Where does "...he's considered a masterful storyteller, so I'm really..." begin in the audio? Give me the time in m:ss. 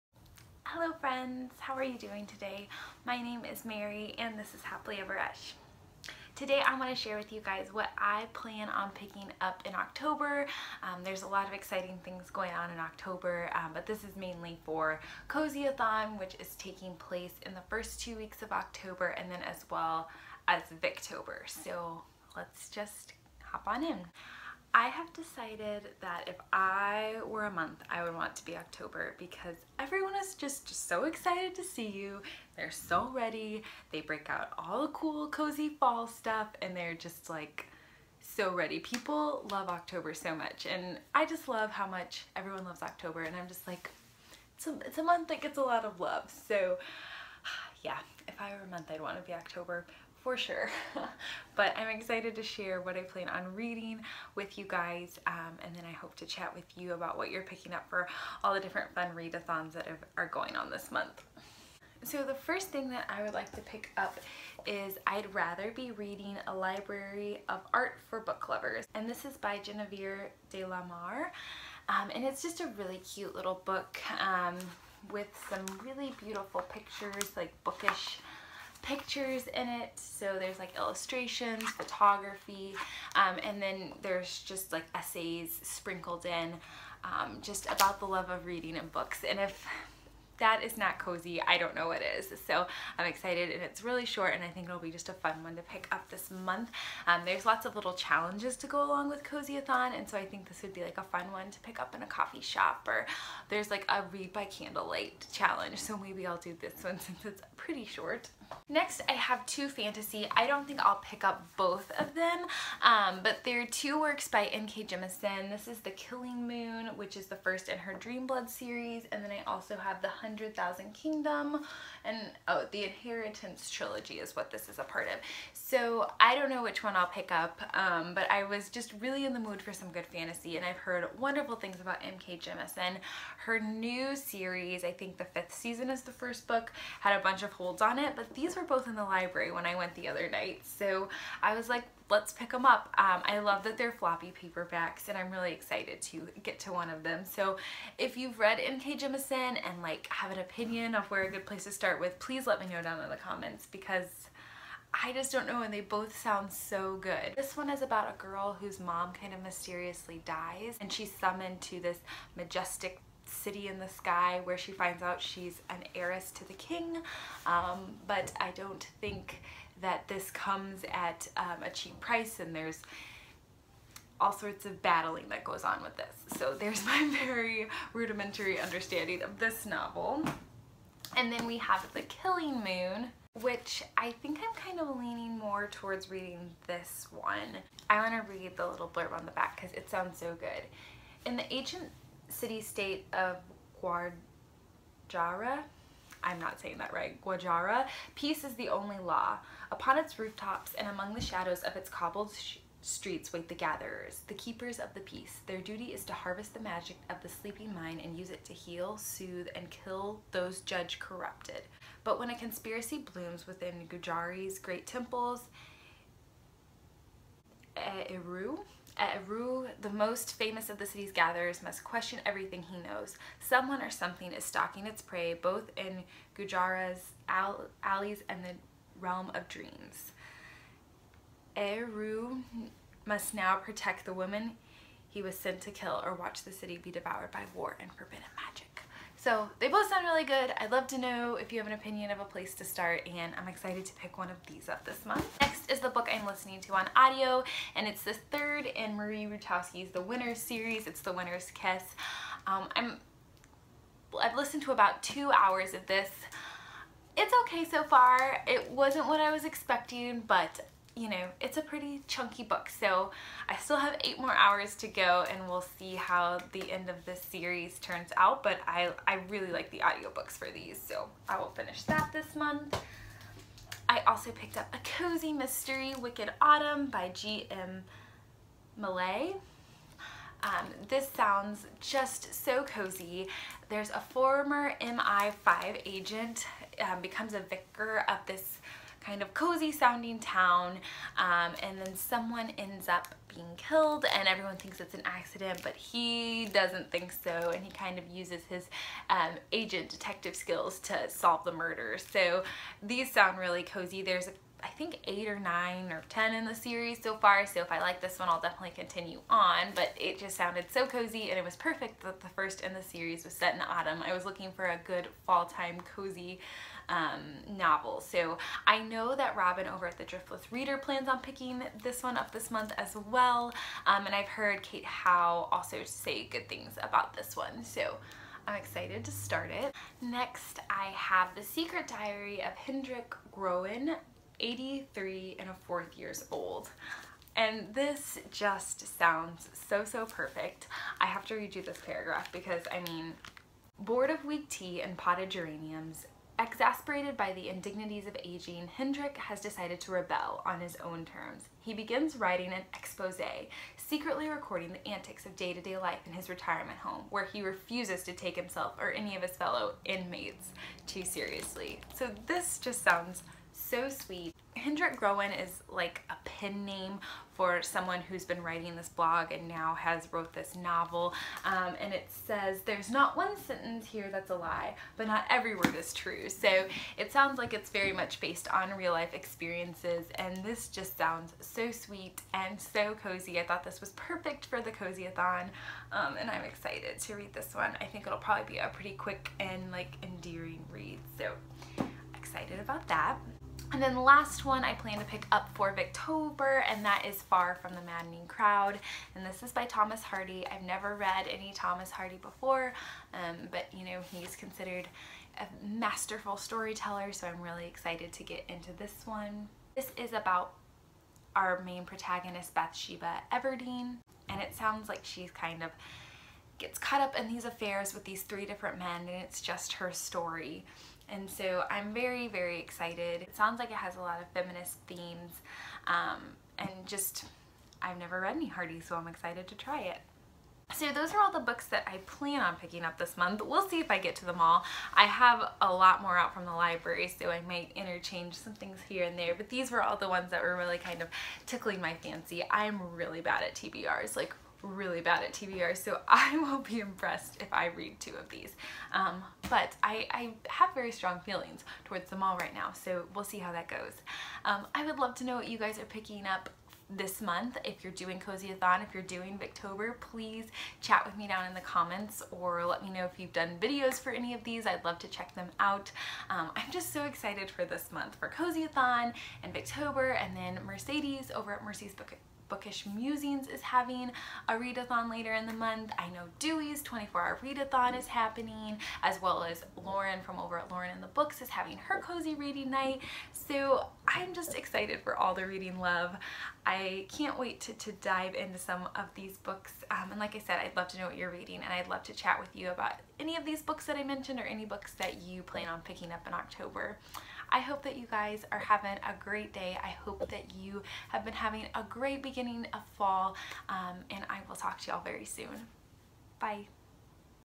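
6:44.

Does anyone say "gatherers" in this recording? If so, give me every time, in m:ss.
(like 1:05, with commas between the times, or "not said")
3:23, 3:41.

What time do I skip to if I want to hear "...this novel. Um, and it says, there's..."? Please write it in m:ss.
6:10.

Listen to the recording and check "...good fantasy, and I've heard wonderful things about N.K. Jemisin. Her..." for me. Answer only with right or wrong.
right.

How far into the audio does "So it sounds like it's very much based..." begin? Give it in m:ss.
6:16.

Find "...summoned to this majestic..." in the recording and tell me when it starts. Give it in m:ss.
2:41.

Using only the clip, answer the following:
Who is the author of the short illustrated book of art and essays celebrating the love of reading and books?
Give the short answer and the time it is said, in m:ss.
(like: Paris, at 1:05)
Genevieve de la Mare, at 1:09.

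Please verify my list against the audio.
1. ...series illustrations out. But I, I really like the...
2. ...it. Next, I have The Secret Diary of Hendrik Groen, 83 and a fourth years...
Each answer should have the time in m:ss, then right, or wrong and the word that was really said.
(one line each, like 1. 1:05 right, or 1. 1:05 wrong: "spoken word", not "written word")
1. 4:27 wrong: "turns", not "illustrations"
2. 5:29 right.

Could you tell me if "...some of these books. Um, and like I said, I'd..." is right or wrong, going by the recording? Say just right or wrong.
right.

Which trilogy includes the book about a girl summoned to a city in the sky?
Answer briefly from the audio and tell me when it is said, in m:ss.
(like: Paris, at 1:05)
The Inheritance trilogy, at 2:02.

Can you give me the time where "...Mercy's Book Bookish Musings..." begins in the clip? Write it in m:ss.
7:51.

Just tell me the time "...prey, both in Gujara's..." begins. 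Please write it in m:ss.
3:45.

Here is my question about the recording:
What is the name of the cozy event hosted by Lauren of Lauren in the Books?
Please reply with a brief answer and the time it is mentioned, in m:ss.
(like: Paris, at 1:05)
cozy reading night, at 8:02.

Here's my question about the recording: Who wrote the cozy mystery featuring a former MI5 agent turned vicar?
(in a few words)
G.M. Malliet.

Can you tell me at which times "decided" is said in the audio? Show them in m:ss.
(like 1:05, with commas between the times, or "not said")
0:25, 5:49.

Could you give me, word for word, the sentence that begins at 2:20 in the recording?
So I was like, let's pick them up.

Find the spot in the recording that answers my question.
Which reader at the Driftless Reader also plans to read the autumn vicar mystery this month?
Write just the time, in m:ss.
5:19.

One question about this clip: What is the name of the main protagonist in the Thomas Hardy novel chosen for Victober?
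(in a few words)
Bathsheba Everdene.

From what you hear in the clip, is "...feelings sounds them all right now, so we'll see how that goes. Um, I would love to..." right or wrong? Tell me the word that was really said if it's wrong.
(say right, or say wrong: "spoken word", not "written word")
wrong: "towards", not "sounds".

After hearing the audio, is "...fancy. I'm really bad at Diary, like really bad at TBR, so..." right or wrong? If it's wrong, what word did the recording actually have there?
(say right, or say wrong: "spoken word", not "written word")
wrong: "TBRs", not "Diary".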